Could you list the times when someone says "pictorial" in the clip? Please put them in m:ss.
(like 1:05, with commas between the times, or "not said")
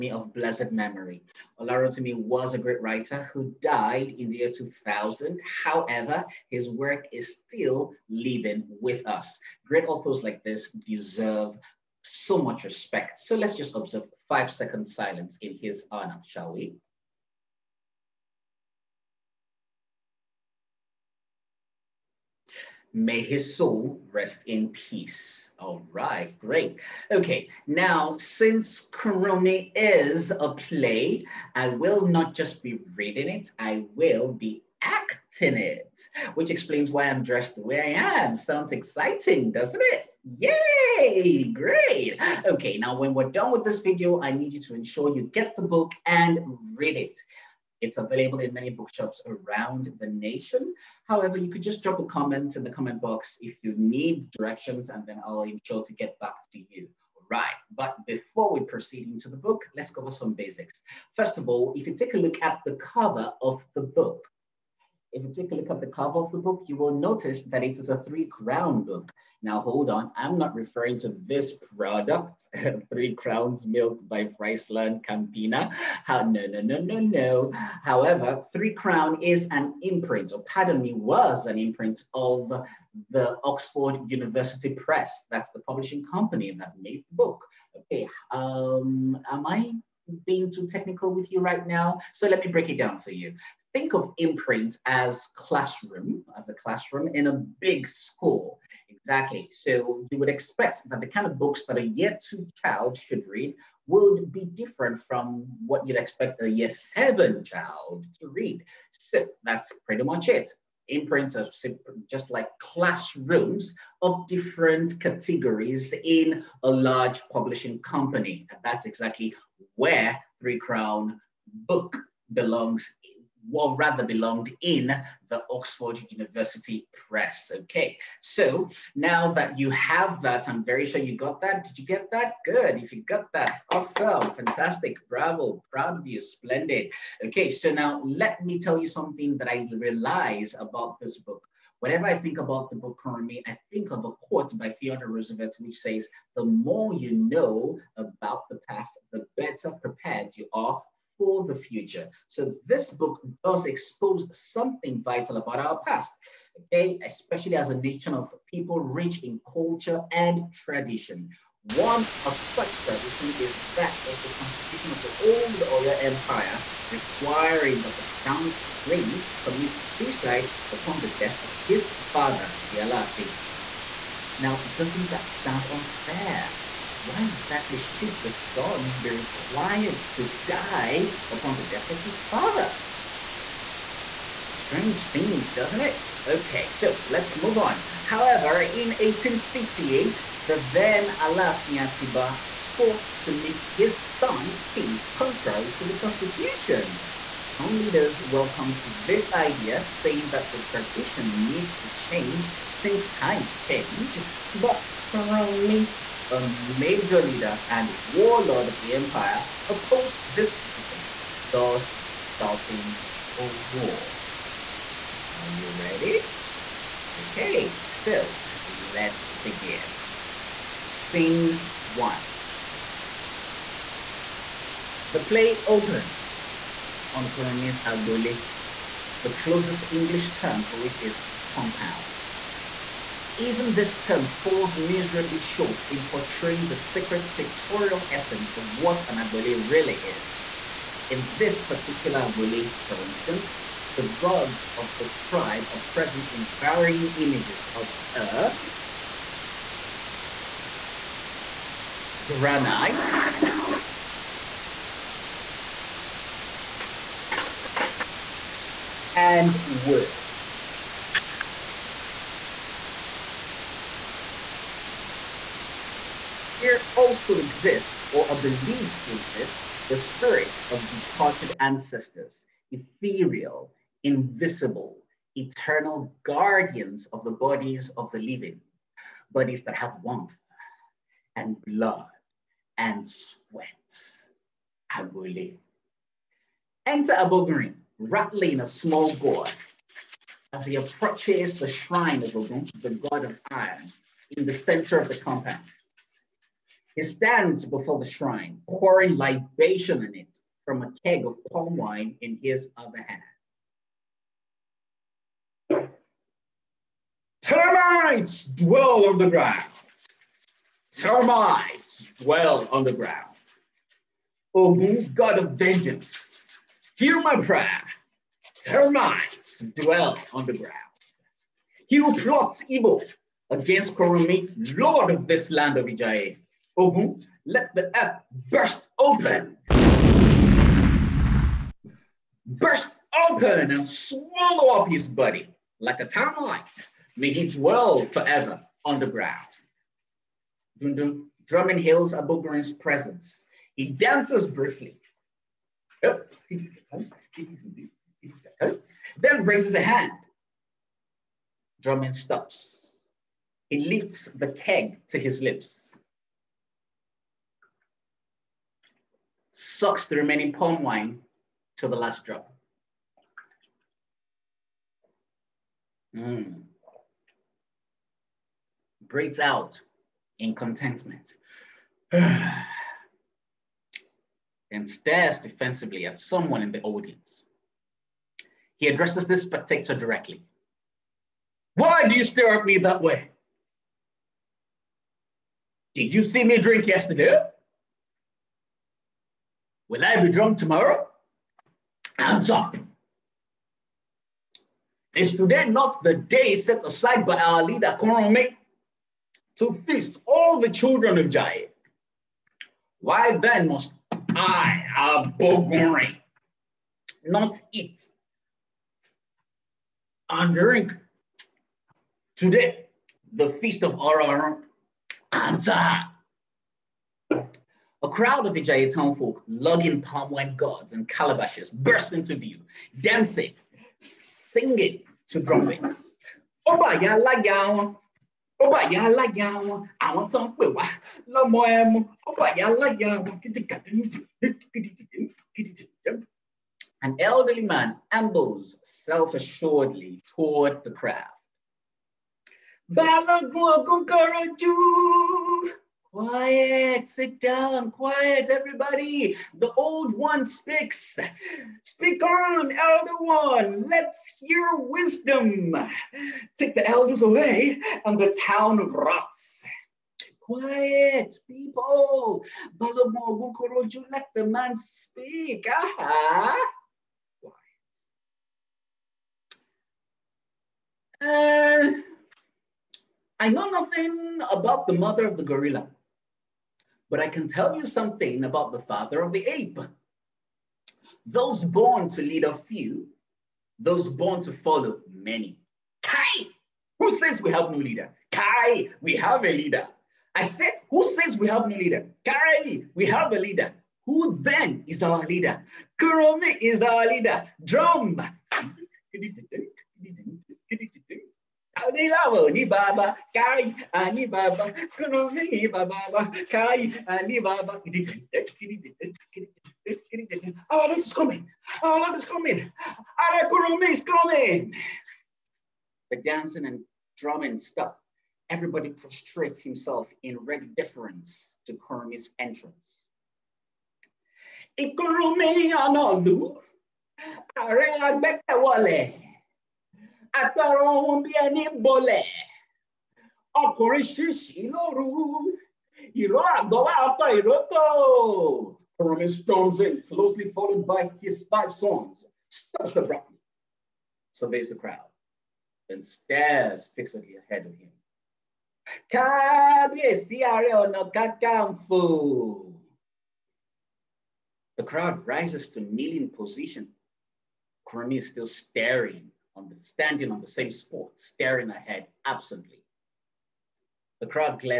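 3:57.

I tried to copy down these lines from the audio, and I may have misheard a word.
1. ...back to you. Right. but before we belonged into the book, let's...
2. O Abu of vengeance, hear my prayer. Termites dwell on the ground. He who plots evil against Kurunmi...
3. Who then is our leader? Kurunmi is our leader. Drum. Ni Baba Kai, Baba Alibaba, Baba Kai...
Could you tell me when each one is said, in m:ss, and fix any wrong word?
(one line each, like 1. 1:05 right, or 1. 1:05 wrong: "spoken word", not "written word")
1. 0:56 wrong: "proceed", not "belonged"
2. 5:14 wrong: "God", not "Abu"
3. 8:14 right.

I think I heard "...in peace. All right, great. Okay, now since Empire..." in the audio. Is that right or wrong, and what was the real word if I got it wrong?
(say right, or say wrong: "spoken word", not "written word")
wrong: "Kurunmi", not "Empire".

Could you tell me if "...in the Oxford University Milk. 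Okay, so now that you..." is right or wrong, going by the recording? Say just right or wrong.
wrong.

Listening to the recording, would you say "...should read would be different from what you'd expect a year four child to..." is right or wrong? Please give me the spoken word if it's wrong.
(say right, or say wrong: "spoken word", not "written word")
wrong: "seven", not "four".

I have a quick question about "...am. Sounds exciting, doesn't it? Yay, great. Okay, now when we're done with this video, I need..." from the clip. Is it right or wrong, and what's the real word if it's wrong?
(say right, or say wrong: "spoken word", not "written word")
right.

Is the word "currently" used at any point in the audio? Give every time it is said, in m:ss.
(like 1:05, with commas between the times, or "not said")
2:22.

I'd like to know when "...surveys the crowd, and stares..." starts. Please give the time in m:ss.
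9:04.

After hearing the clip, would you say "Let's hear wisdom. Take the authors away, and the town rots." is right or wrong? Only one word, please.
wrong.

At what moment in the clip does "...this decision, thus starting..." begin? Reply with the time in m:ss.
3:30.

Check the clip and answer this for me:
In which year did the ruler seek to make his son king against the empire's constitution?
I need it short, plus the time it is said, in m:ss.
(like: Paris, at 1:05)
1858, at 3:08.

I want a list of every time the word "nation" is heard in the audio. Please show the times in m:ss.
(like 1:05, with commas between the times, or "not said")
0:50, 2:37.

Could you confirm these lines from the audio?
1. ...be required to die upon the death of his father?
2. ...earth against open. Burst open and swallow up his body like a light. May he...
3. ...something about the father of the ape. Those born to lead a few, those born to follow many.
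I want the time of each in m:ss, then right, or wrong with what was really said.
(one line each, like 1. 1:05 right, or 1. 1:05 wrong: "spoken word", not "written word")
1. 2:58 right
2. 5:27 wrong: "burst", not "against"
3. 7:57 right.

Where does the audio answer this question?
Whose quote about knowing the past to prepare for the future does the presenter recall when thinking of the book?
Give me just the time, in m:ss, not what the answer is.
2:24.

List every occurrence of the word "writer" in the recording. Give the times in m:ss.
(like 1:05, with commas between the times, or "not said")
0:02.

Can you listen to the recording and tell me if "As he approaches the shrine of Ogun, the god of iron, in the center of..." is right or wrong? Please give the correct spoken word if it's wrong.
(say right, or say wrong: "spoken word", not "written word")
right.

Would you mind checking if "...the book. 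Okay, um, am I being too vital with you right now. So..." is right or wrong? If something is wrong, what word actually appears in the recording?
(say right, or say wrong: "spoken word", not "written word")
wrong: "technical", not "vital".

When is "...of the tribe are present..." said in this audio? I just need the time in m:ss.
4:04.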